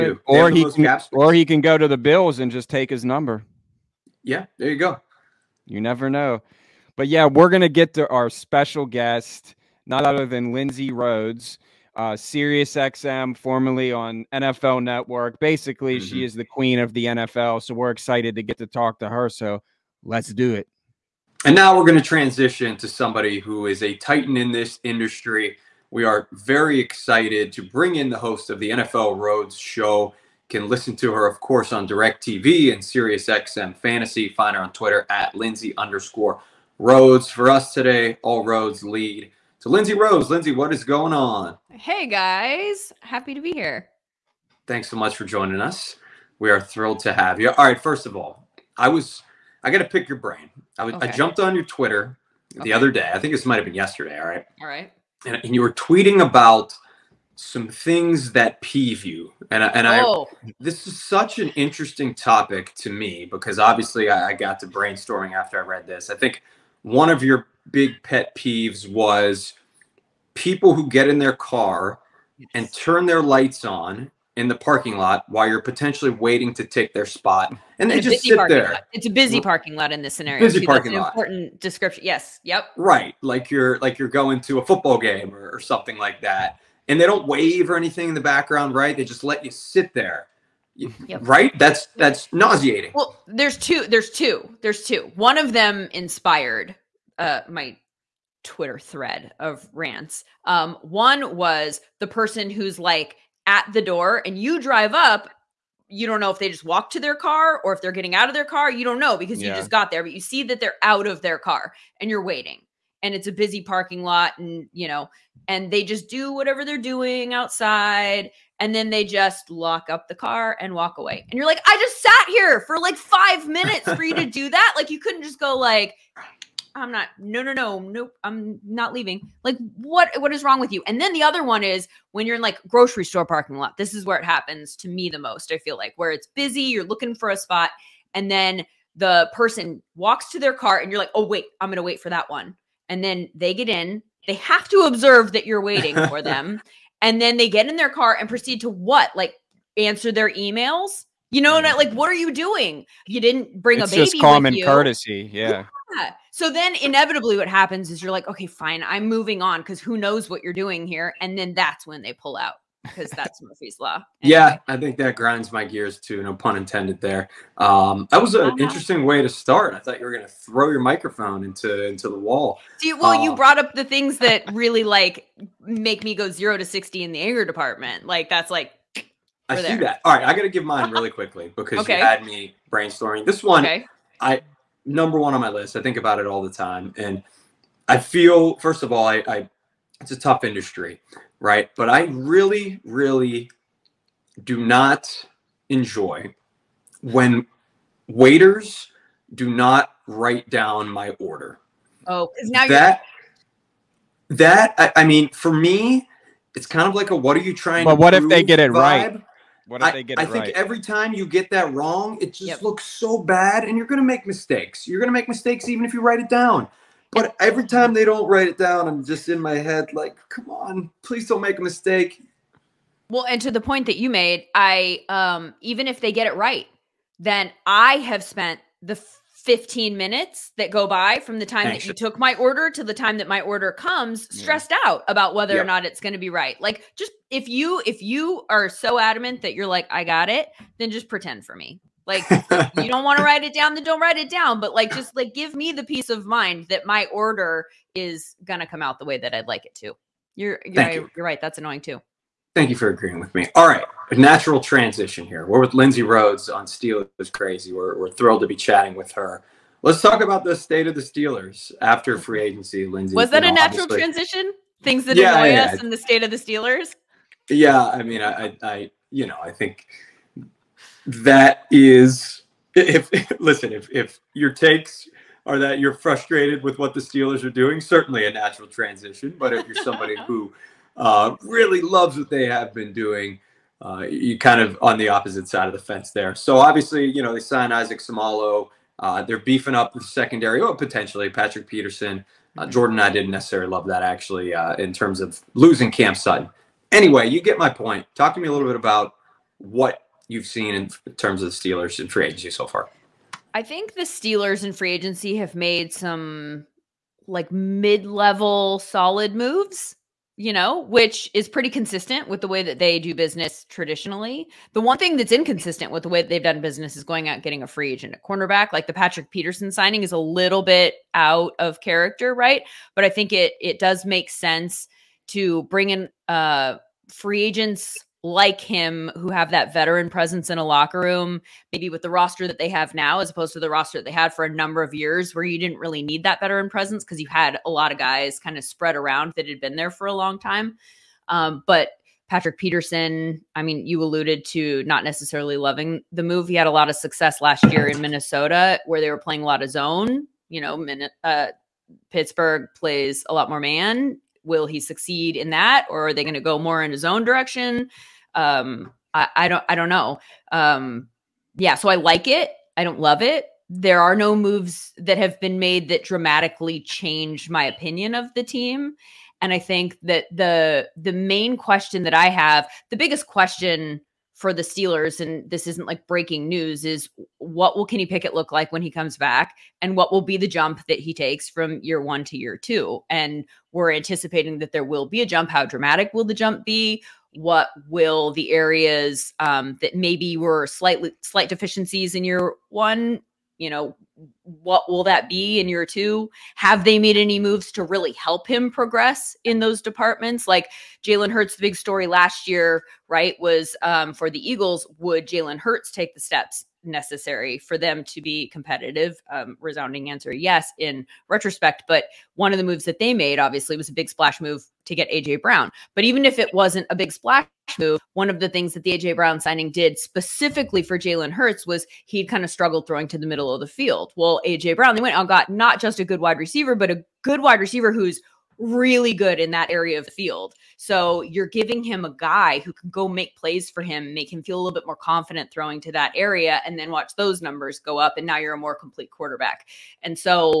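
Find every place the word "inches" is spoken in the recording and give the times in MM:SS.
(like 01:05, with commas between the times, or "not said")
not said.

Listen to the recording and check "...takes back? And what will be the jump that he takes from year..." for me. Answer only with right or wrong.
wrong.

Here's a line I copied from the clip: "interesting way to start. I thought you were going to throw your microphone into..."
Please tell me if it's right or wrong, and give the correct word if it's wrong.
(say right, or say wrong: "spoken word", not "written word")
right.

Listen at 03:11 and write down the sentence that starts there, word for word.
But I really, really do not enjoy when waiters do not write down my order.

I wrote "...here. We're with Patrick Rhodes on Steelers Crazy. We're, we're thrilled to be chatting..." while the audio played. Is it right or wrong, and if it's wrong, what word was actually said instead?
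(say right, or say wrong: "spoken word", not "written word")
wrong: "Lindsay", not "Patrick".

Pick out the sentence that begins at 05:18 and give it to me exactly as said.
Like the Patrick Peterson signing is a little bit out of character, right?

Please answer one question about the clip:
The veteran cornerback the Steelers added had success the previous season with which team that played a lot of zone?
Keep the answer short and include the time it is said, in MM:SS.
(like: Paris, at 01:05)
Minnesota, at 05:48.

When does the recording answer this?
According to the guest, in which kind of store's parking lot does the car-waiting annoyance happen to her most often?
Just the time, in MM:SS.
02:12.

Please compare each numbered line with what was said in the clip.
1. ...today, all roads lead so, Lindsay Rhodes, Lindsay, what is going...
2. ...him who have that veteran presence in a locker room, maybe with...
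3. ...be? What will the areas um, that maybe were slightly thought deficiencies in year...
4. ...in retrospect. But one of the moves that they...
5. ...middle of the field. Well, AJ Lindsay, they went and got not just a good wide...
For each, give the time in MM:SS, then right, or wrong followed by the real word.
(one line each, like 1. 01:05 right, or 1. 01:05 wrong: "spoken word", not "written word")
1. 00:37 right
2. 05:28 right
3. 06:26 wrong: "slight", not "thought"
4. 06:50 right
5. 07:03 wrong: "Brown", not "Lindsay".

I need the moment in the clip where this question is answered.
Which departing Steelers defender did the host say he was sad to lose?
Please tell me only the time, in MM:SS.
04:55.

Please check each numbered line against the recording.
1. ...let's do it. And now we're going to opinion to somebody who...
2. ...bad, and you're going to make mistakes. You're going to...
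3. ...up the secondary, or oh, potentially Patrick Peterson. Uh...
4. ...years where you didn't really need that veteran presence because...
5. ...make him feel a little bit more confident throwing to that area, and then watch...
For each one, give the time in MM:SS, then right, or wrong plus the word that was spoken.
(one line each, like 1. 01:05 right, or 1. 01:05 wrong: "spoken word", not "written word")
1. 00:20 wrong: "transition", not "opinion"
2. 03:33 right
3. 04:49 right
4. 05:34 right
5. 07:14 right.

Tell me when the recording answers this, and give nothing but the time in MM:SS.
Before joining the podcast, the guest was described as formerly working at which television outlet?
00:14.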